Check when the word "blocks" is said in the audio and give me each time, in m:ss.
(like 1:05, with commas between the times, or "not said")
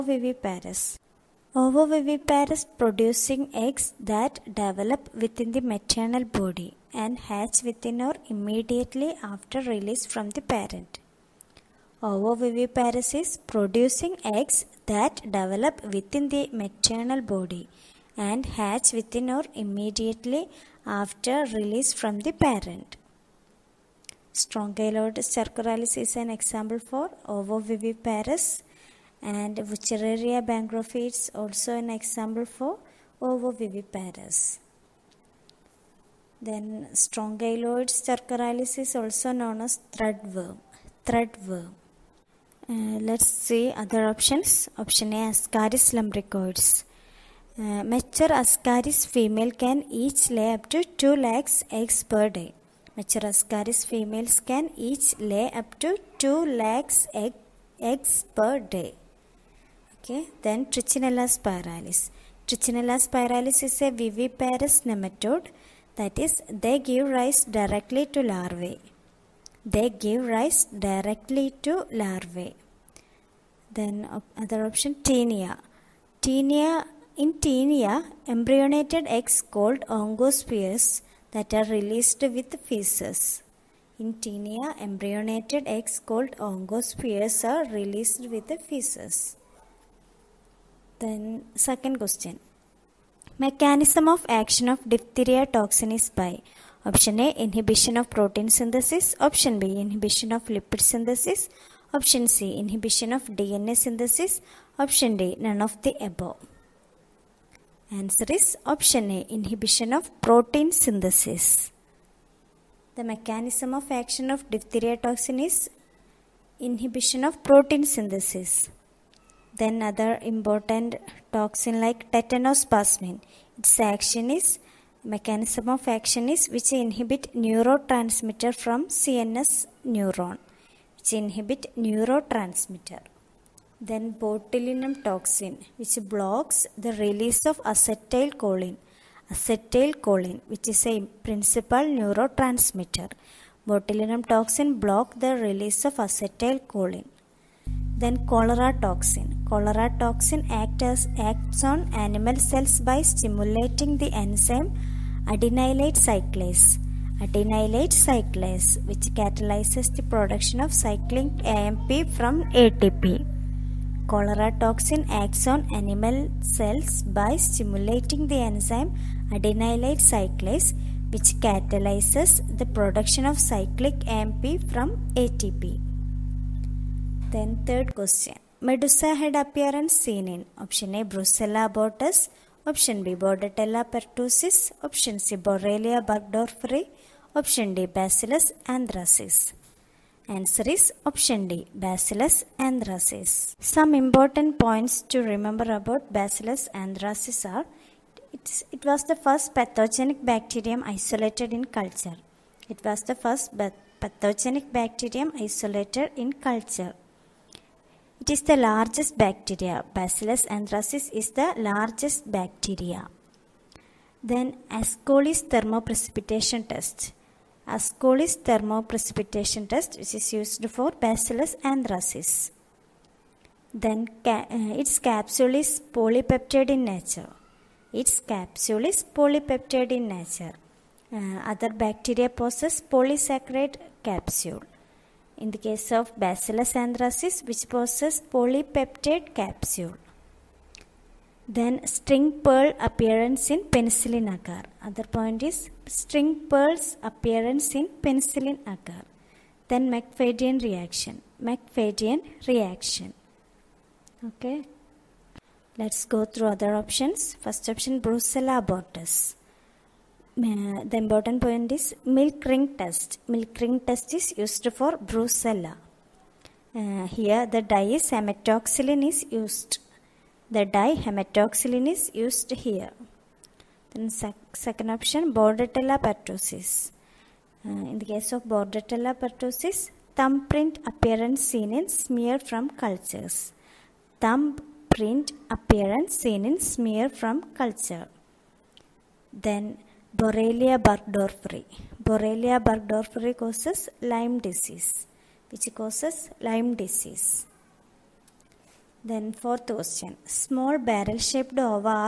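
2:16, 2:24.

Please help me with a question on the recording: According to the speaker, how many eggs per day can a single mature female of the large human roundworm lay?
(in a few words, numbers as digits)
2 lakhs.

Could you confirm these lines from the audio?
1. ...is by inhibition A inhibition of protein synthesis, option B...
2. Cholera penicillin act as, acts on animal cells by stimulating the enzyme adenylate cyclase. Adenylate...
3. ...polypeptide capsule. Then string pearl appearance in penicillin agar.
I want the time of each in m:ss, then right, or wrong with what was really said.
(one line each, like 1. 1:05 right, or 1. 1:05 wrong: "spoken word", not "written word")
1. 1:35 wrong: "option", not "inhibition"
2. 2:29 wrong: "toxin", not "penicillin"
3. 3:58 right.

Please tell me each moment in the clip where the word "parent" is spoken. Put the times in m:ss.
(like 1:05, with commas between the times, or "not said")
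0:10, 0:22.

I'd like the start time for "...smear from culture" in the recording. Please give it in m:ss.
4:46.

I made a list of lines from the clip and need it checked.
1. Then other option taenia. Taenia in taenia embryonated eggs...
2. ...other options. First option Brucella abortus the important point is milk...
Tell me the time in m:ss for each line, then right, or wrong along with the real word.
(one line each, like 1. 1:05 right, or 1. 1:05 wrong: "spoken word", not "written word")
1. 1:13 right
2. 4:16 right.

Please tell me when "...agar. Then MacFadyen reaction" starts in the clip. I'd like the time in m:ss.
4:08.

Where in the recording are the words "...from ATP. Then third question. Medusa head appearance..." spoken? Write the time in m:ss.
2:54.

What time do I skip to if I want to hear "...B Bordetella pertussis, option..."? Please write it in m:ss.
3:03.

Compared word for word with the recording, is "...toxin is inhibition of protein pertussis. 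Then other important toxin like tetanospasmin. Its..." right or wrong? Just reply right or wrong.
wrong.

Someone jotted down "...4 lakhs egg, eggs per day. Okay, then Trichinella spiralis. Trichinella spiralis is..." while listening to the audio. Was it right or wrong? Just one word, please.
wrong.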